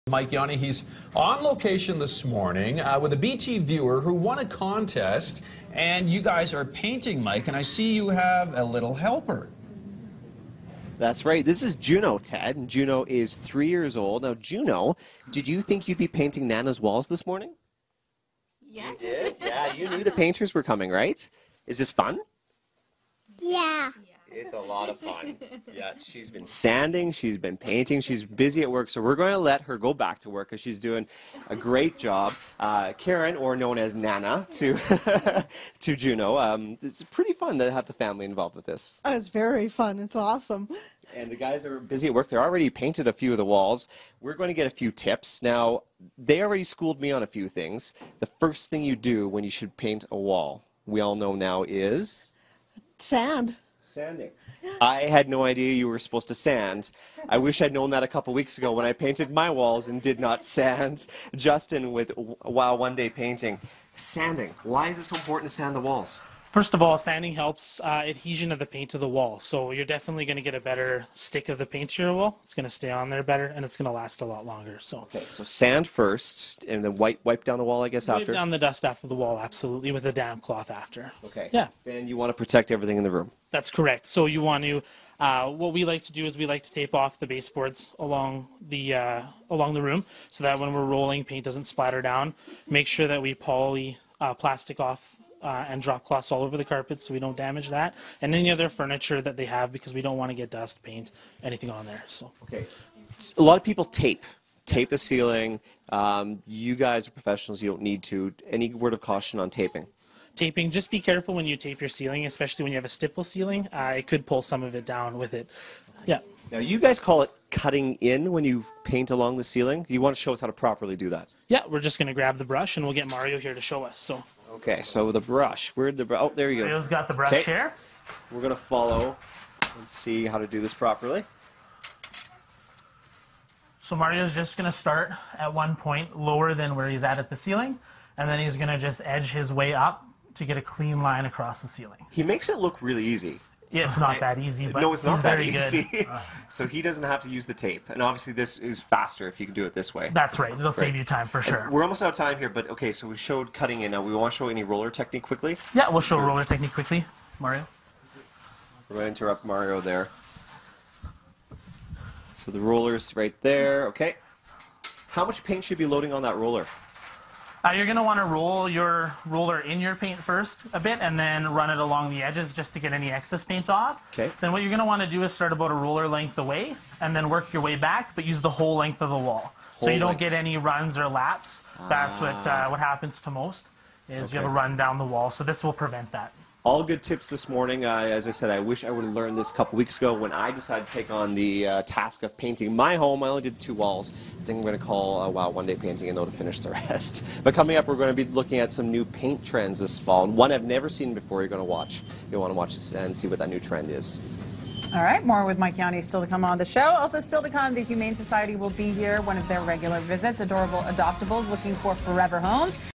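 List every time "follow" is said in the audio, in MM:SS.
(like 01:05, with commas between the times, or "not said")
02:08.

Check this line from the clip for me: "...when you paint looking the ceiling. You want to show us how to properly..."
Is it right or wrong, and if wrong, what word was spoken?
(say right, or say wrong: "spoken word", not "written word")
wrong: "along", not "looking".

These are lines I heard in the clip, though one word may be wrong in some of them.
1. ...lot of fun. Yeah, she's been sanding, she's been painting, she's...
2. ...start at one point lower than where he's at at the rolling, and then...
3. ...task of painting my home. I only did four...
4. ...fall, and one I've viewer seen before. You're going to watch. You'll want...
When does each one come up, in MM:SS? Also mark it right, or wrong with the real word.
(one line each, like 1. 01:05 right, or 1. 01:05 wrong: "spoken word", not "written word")
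1. 00:24 right
2. 02:14 wrong: "ceiling", not "rolling"
3. 03:11 wrong: "two", not "four"
4. 03:19 wrong: "never", not "viewer".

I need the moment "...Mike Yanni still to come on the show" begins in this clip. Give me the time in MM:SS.
03:25.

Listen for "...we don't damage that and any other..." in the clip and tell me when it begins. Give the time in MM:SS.
01:37.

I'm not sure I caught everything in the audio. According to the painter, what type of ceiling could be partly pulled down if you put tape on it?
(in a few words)
Stipple ceiling.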